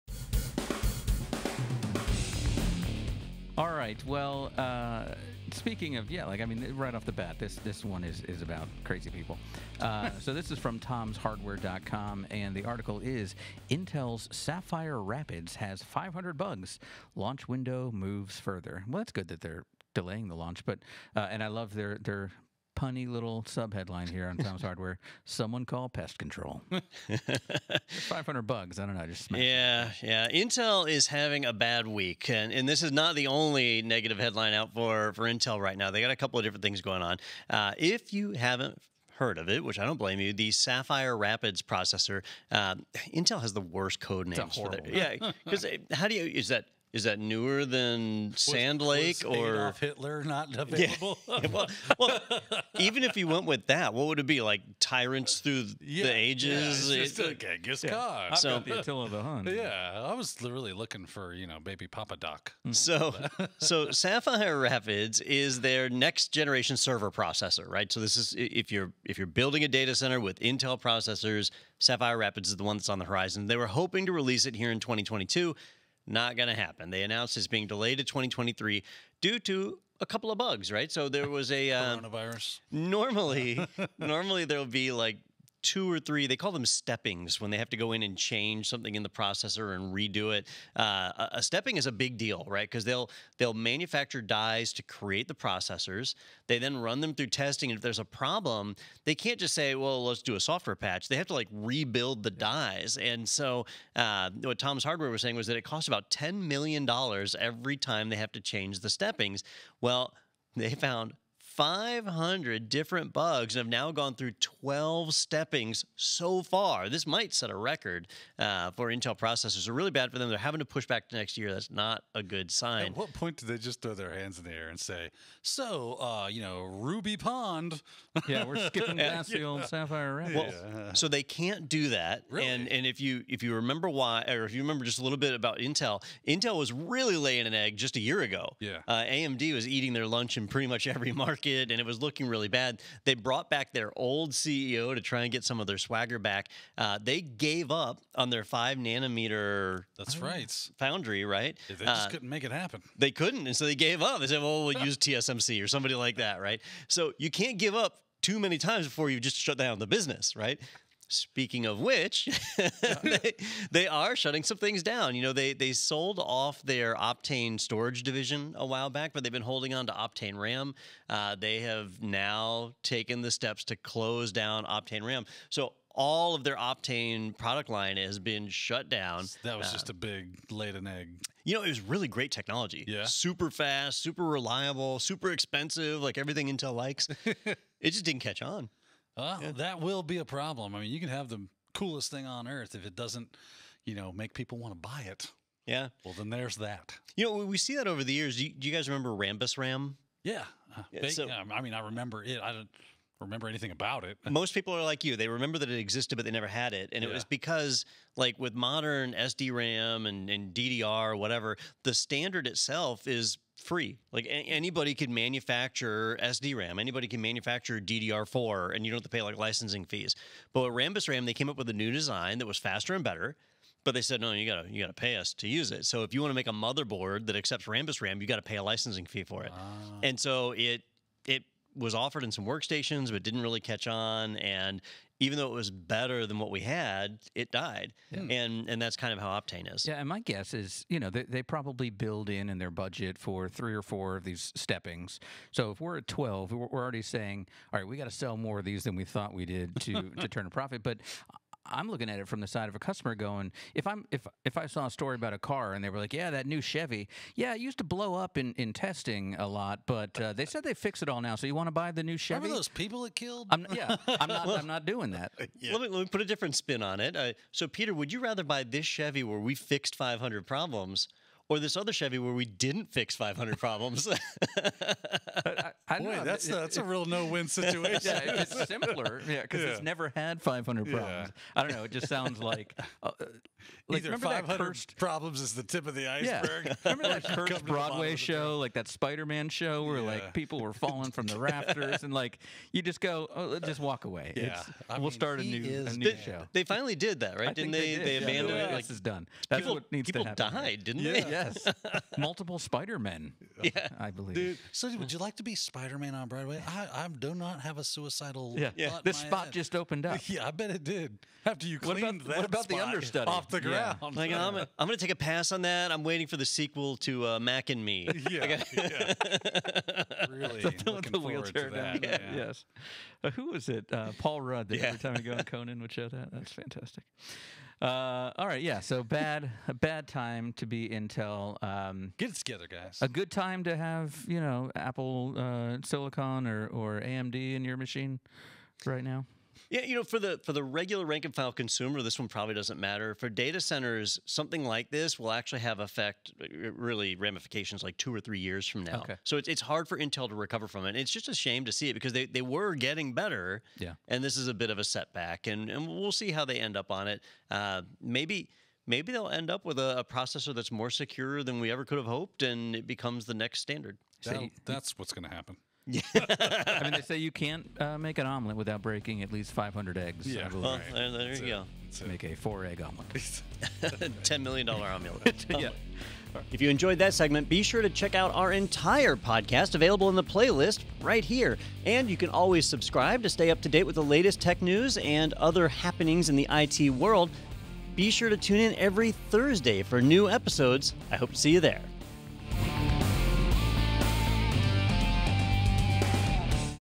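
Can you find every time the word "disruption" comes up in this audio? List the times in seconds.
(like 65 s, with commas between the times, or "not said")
not said.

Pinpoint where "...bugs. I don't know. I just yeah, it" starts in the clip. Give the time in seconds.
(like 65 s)
28 s.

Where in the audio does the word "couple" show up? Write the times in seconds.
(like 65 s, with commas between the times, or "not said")
36 s, 80 s.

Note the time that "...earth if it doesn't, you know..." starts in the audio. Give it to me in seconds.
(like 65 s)
192 s.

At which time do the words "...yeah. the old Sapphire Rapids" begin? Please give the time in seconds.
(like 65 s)
129 s.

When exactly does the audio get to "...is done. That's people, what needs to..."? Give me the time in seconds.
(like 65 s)
298 s.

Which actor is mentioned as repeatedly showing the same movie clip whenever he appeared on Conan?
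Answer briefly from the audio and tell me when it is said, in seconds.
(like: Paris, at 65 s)
Paul Rudd, at 324 s.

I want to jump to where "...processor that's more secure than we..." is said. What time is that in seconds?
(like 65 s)
360 s.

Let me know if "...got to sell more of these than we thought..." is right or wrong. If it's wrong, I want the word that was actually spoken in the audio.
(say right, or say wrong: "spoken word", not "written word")
right.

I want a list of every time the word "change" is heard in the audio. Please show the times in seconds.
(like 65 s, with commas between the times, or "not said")
88 s, 108 s.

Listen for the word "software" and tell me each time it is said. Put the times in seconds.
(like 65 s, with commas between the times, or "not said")
100 s.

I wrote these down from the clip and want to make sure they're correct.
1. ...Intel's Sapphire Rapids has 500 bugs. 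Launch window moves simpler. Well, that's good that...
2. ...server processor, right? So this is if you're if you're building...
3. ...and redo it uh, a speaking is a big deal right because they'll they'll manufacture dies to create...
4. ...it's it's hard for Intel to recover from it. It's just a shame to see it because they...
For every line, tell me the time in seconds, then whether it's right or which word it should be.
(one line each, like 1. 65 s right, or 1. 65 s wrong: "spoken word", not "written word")
1. 13 s wrong: "further", not "simpler"
2. 66 s right
3. 89 s wrong: "stepping", not "speaking"
4. 349 s right.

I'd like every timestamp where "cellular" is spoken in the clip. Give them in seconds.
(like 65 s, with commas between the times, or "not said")
not said.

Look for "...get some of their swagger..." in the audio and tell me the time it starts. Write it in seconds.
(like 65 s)
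145 s.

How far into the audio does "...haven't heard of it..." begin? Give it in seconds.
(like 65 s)
38 s.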